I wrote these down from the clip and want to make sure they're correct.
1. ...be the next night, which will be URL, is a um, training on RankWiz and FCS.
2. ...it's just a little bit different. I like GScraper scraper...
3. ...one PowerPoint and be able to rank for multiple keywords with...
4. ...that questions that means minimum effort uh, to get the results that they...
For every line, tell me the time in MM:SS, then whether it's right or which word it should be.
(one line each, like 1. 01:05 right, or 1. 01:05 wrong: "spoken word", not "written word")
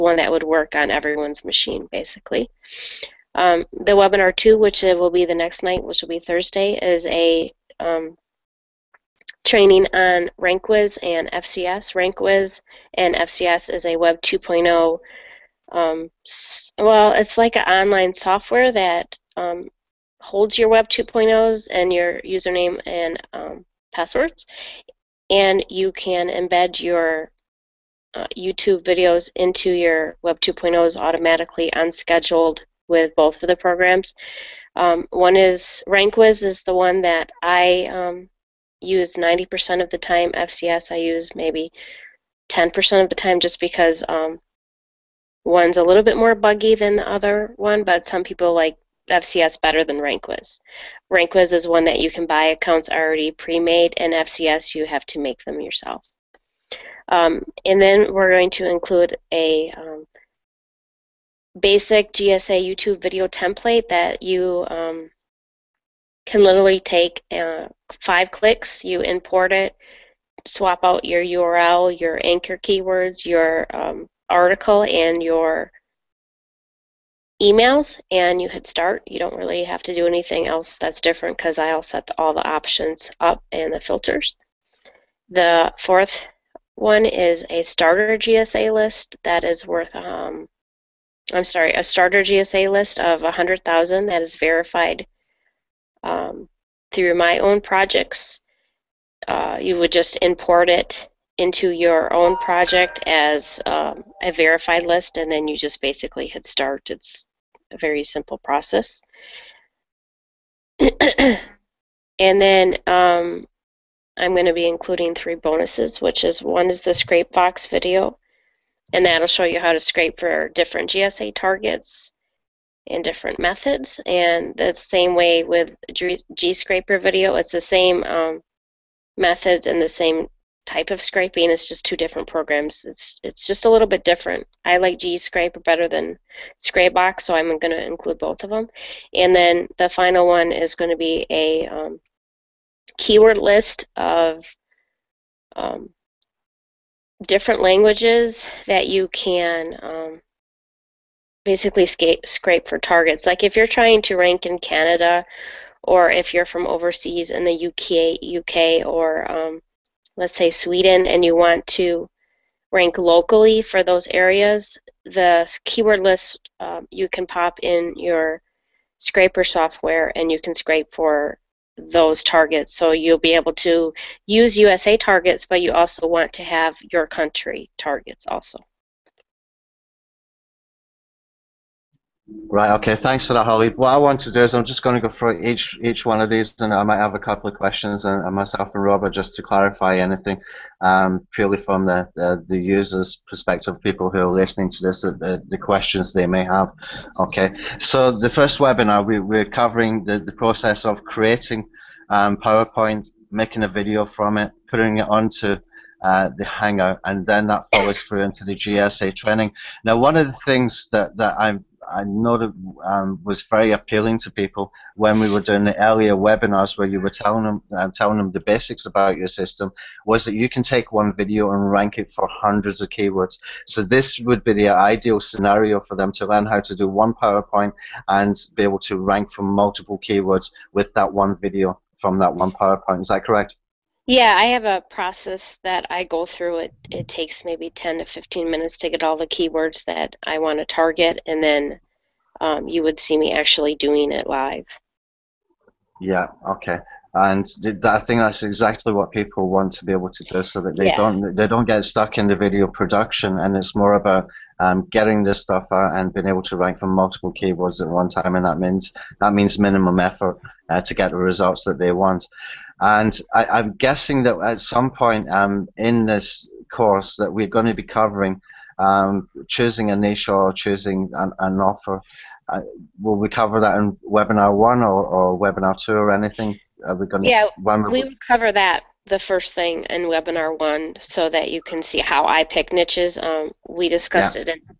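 1. 00:05 wrong: "Thursday", not "URL"
2. 02:13 wrong: "better", not "scraper"
3. 03:46 right
4. 04:18 wrong: "means", not "questions".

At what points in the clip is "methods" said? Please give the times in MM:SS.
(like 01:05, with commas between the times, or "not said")
02:03, 02:09.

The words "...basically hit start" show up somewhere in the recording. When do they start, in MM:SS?
01:45.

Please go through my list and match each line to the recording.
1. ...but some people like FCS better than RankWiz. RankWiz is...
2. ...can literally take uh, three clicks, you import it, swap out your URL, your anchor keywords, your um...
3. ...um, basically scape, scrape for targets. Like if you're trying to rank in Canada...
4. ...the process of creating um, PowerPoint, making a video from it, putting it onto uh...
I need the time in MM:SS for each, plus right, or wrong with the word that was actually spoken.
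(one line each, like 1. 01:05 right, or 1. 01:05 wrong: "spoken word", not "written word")
1. 00:47 right
2. 01:06 wrong: "five", not "three"
3. 02:29 right
4. 03:20 right.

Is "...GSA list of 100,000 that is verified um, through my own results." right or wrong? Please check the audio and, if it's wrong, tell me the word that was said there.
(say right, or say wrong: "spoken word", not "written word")
wrong: "projects", not "results".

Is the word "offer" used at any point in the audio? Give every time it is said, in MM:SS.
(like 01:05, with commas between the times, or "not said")
04:31.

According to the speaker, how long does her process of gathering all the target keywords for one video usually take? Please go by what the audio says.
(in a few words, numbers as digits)
10 to 15 minutes.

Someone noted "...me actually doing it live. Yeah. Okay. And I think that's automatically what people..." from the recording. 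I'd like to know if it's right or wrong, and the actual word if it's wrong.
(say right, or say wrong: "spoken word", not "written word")
wrong: "exactly", not "automatically".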